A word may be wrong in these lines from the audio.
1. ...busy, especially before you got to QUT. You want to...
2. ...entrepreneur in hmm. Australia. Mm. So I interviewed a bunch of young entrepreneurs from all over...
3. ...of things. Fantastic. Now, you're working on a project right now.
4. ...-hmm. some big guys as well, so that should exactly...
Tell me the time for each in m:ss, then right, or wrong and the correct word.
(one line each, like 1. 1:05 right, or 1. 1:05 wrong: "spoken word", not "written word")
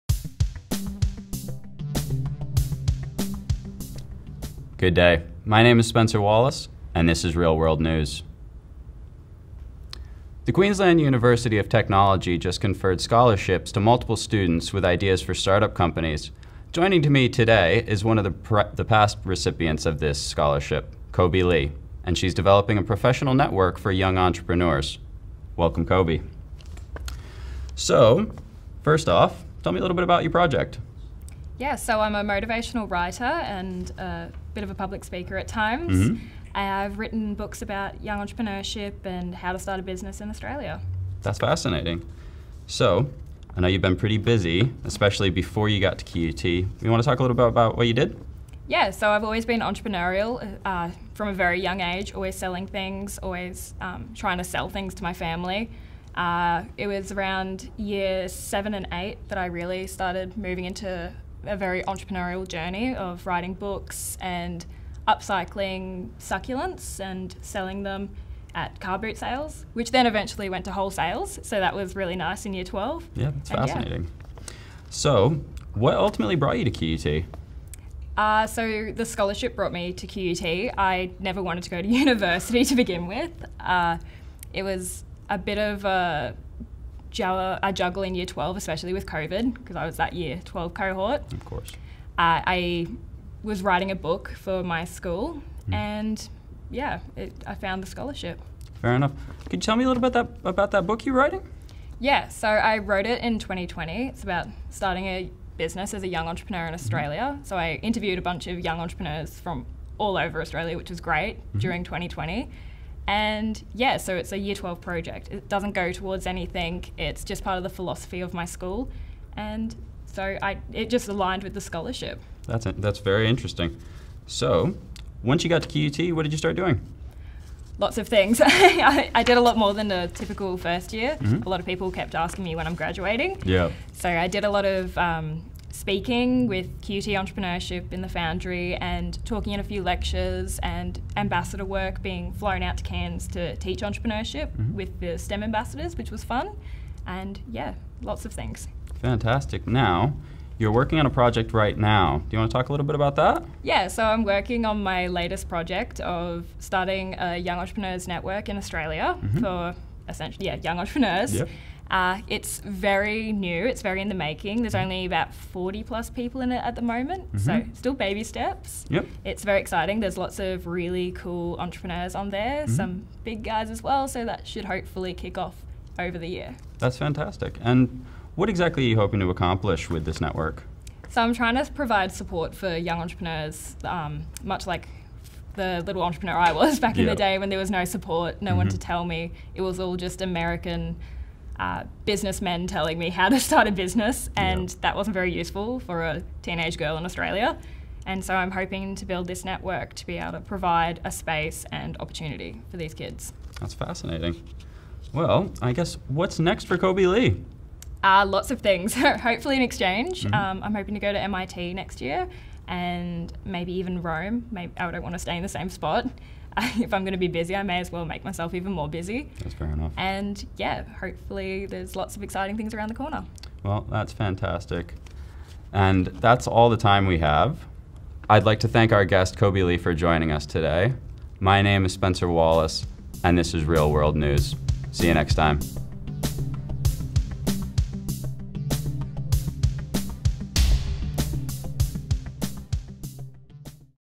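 1. 0:44 right
2. 1:46 right
3. 2:28 right
4. 2:52 wrong: "hopefully", not "exactly".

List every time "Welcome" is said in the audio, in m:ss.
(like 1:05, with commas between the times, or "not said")
0:25.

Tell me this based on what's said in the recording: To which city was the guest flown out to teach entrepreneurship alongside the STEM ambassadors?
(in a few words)
Cairns.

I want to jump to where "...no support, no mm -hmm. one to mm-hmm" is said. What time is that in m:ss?
3:07.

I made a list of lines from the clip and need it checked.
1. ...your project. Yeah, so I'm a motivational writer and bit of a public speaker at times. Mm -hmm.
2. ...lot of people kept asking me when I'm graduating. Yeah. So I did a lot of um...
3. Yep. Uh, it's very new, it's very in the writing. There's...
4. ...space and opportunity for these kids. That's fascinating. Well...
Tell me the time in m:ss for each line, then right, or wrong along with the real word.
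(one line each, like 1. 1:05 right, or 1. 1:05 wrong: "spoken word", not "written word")
1. 0:30 right
2. 2:11 right
3. 2:41 wrong: "making", not "writing"
4. 3:21 right.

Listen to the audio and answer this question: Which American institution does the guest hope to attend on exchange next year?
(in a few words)
MIT.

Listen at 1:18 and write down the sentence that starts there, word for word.
Uh, so, the scholarship brought me to QUT.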